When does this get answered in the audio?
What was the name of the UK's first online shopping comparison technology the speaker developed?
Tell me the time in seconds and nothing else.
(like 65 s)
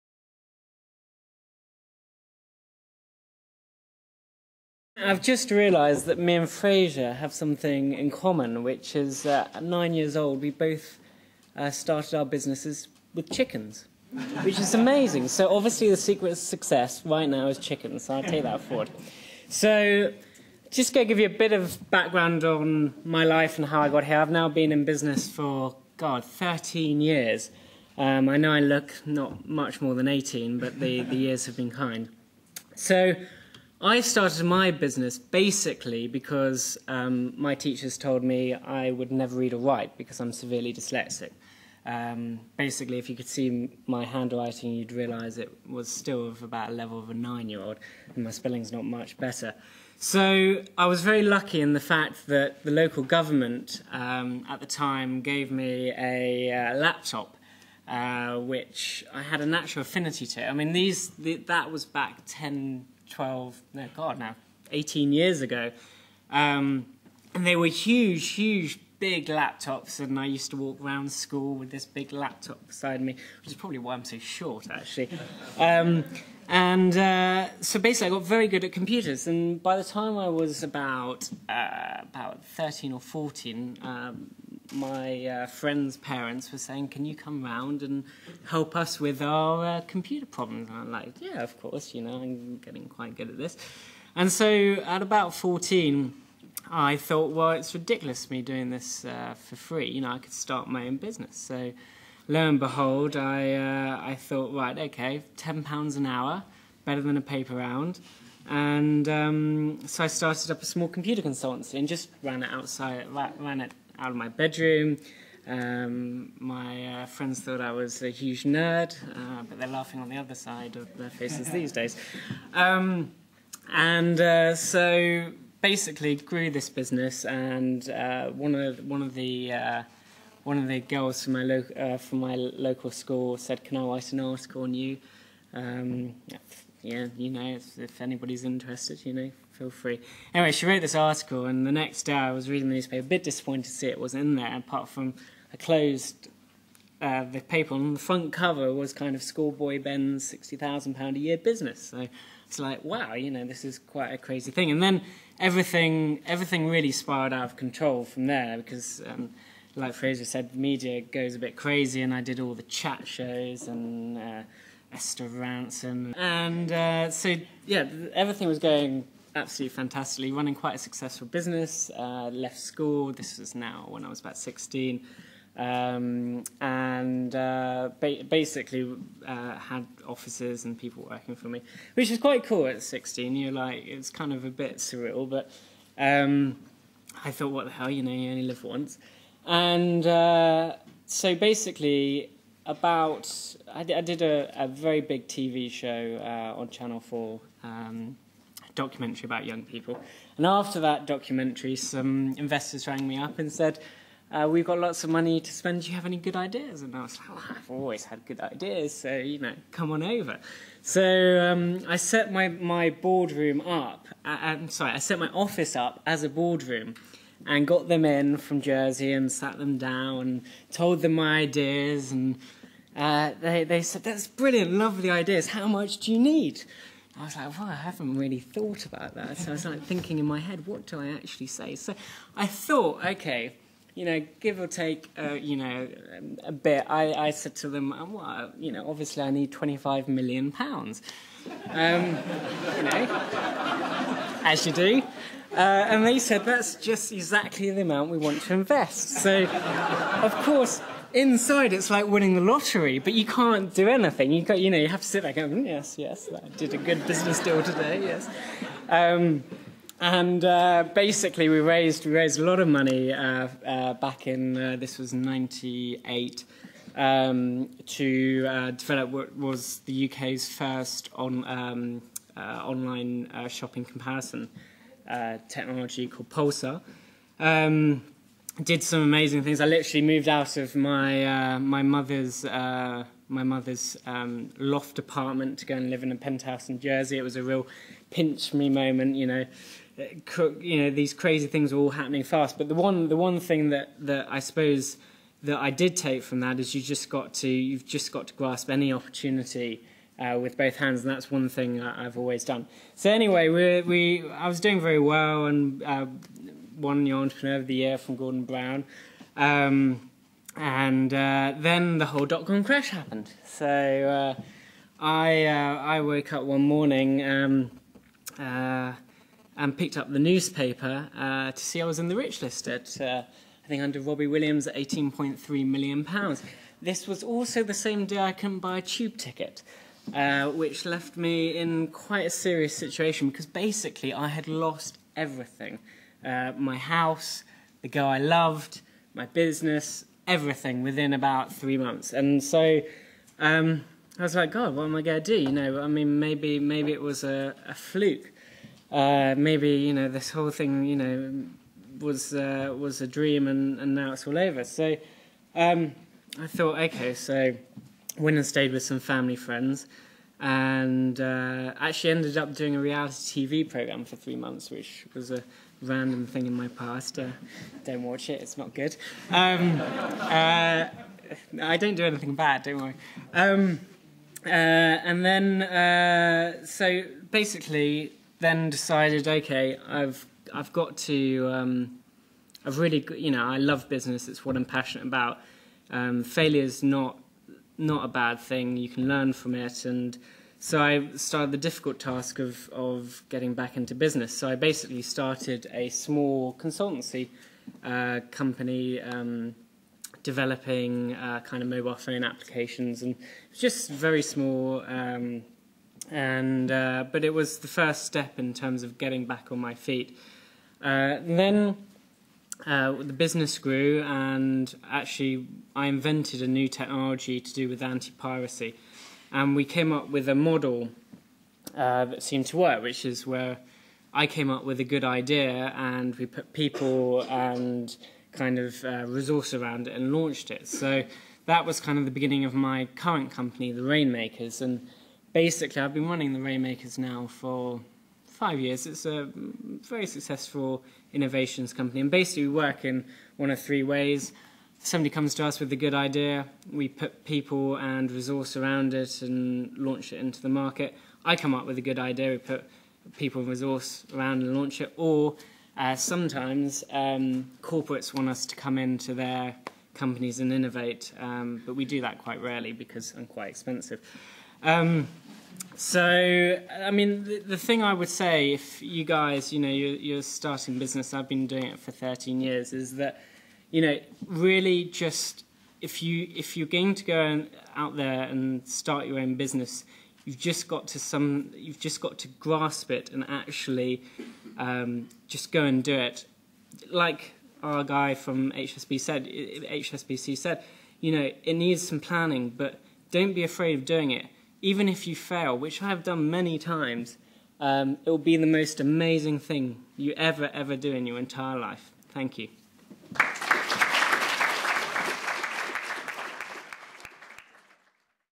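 276 s.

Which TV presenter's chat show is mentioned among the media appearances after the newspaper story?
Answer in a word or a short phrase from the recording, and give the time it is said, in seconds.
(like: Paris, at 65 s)
Esther Rantzen, at 164 s.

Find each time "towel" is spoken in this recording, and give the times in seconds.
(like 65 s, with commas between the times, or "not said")
not said.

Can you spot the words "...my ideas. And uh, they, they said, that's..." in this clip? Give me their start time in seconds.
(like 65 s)
221 s.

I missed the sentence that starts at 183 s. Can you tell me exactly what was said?
You're like, it's kind of a bit surreal, but um, I thought, what the hell, you know, you only live once.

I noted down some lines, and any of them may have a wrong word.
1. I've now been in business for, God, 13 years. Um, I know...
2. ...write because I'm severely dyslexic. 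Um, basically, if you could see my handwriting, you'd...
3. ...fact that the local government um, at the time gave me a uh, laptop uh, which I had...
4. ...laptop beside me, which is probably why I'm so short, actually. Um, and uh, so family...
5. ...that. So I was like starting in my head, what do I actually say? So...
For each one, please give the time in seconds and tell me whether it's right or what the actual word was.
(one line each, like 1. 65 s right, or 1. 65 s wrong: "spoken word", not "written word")
1. 24 s right
2. 39 s right
3. 51 s right
4. 72 s wrong: "basically", not "family"
5. 229 s wrong: "thinking", not "starting".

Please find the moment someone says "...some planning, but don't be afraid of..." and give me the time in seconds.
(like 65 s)
491 s.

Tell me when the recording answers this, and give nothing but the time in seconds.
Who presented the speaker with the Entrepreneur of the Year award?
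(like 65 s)
308 s.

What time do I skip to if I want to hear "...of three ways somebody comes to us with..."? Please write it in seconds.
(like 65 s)
443 s.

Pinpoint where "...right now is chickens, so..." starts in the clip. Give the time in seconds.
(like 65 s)
17 s.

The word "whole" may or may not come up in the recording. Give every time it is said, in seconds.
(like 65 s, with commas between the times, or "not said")
312 s, 350 s.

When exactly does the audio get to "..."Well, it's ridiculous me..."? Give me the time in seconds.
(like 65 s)
97 s.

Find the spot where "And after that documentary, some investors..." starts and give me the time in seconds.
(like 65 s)
200 s.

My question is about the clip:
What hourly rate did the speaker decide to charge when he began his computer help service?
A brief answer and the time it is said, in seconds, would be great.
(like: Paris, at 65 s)
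£10 an hour, at 105 s.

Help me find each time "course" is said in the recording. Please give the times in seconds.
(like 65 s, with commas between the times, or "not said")
91 s, 250 s.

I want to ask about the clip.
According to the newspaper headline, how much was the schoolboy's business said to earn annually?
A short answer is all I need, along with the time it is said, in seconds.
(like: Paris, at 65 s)
£60,000, at 150 s.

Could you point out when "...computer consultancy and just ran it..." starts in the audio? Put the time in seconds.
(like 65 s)
110 s.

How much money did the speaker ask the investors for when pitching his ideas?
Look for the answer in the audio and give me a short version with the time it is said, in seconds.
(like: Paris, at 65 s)
25 million pounds, at 239 s.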